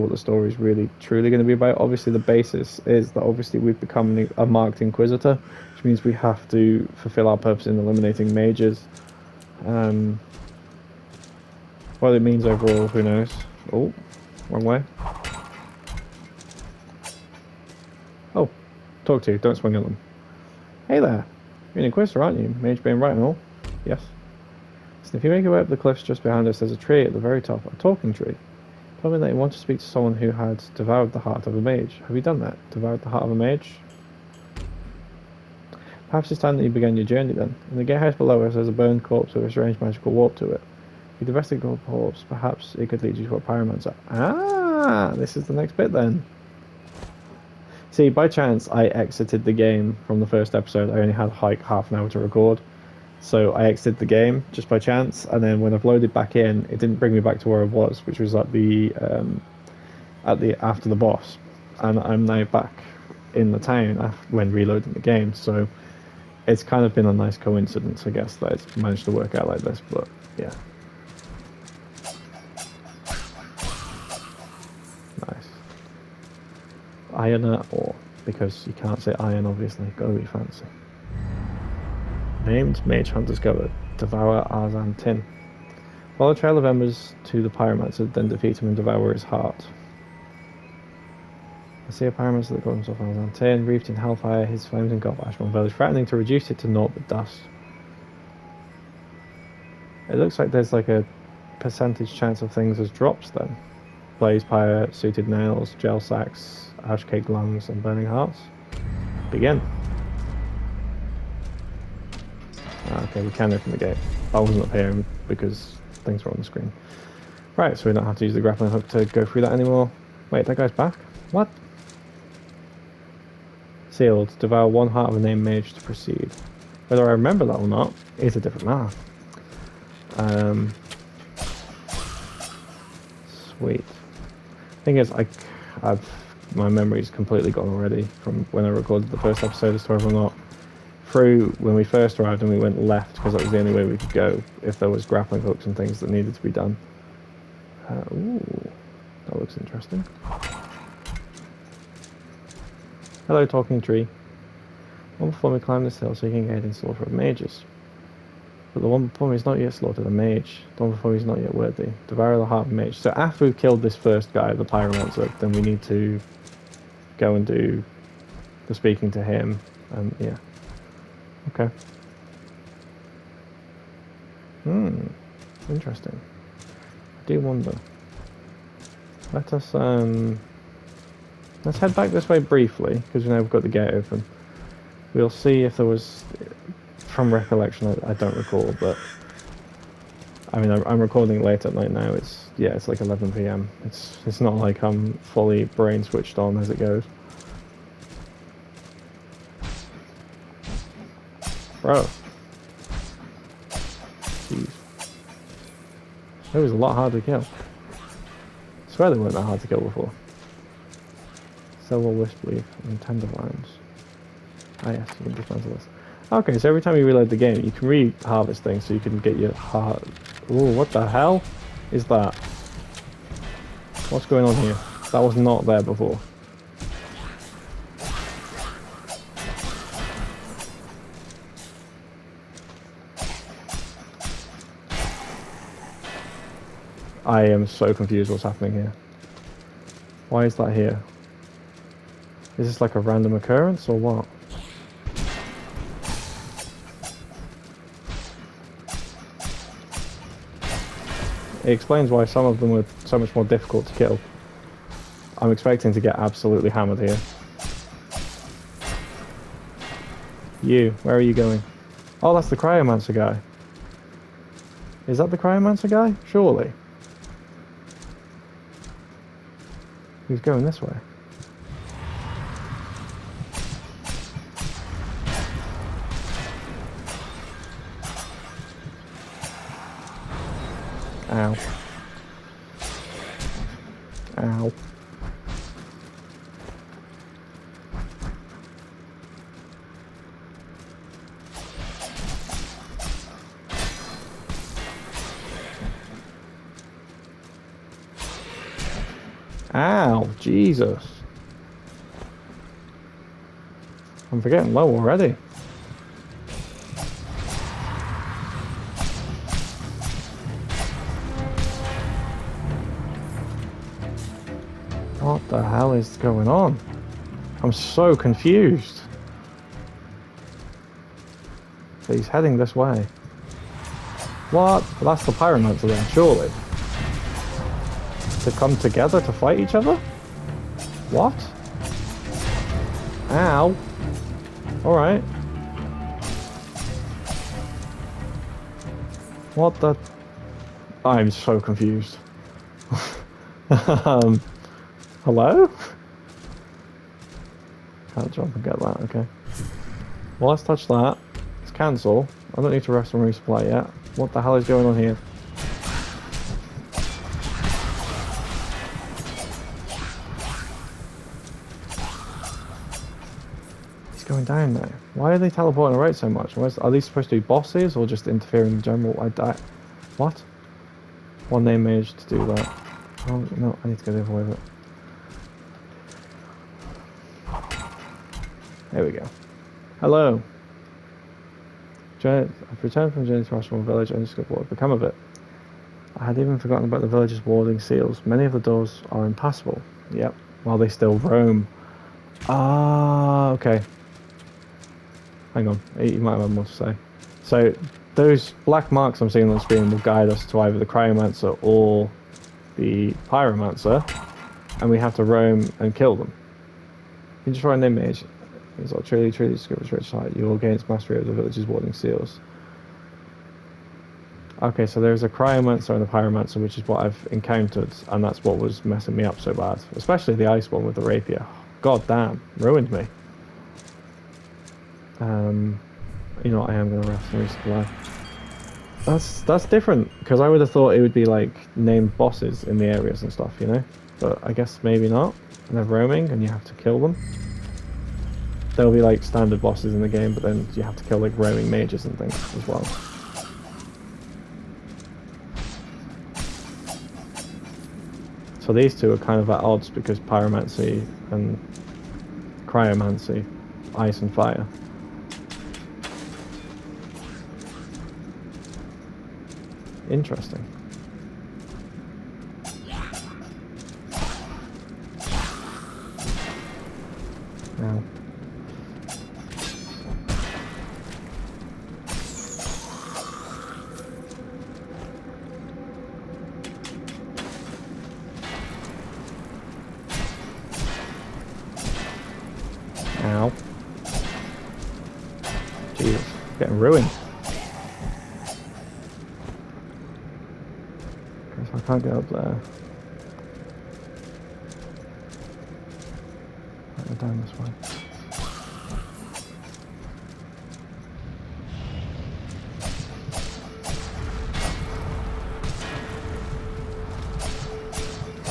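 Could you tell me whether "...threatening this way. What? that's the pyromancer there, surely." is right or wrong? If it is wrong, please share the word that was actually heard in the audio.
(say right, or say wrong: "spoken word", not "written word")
wrong: "heading", not "threatening".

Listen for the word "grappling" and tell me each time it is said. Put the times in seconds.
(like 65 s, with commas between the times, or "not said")
118 s, 145 s.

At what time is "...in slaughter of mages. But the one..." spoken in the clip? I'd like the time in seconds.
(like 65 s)
156 s.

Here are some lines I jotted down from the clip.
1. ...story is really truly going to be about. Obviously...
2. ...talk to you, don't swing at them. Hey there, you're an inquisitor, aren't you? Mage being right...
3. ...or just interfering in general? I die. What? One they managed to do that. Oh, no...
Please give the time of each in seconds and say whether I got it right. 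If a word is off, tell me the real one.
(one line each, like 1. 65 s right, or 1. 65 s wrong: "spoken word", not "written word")
1. 0 s right
2. 19 s right
3. 367 s right.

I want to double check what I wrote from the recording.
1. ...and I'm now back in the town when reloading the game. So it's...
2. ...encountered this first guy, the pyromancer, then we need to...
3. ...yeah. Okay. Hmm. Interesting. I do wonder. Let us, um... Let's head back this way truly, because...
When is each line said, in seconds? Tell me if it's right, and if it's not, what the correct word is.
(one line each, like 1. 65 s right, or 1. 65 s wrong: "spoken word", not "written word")
1. 61 s right
2. 163 s wrong: "killed", not "encountered"
3. 170 s wrong: "briefly", not "truly".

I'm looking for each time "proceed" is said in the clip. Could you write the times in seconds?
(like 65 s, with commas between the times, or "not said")
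125 s.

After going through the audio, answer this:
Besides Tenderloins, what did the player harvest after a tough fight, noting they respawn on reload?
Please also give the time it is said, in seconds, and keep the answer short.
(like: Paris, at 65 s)
Wisp Leaf, at 212 s.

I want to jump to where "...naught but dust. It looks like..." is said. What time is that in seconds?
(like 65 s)
96 s.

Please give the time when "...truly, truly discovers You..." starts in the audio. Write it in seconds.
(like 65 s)
409 s.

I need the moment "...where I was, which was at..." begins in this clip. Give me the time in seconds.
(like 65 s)
57 s.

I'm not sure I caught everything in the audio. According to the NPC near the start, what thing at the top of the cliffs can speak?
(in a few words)
A talking tree.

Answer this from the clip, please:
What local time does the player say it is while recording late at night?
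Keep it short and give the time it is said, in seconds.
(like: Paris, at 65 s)
11 p.m., at 192 s.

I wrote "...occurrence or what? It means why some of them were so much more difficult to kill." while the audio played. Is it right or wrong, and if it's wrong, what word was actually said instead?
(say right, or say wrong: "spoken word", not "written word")
wrong: "explains", not "means".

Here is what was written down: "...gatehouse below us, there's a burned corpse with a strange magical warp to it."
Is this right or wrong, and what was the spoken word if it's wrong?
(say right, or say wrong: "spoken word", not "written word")
right.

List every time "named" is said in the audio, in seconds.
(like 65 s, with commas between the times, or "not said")
82 s, 125 s, 431 s.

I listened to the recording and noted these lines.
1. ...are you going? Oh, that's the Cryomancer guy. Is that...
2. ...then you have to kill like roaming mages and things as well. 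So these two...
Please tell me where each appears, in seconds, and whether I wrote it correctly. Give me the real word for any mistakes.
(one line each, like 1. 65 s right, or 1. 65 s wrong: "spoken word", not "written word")
1. 261 s right
2. 440 s right.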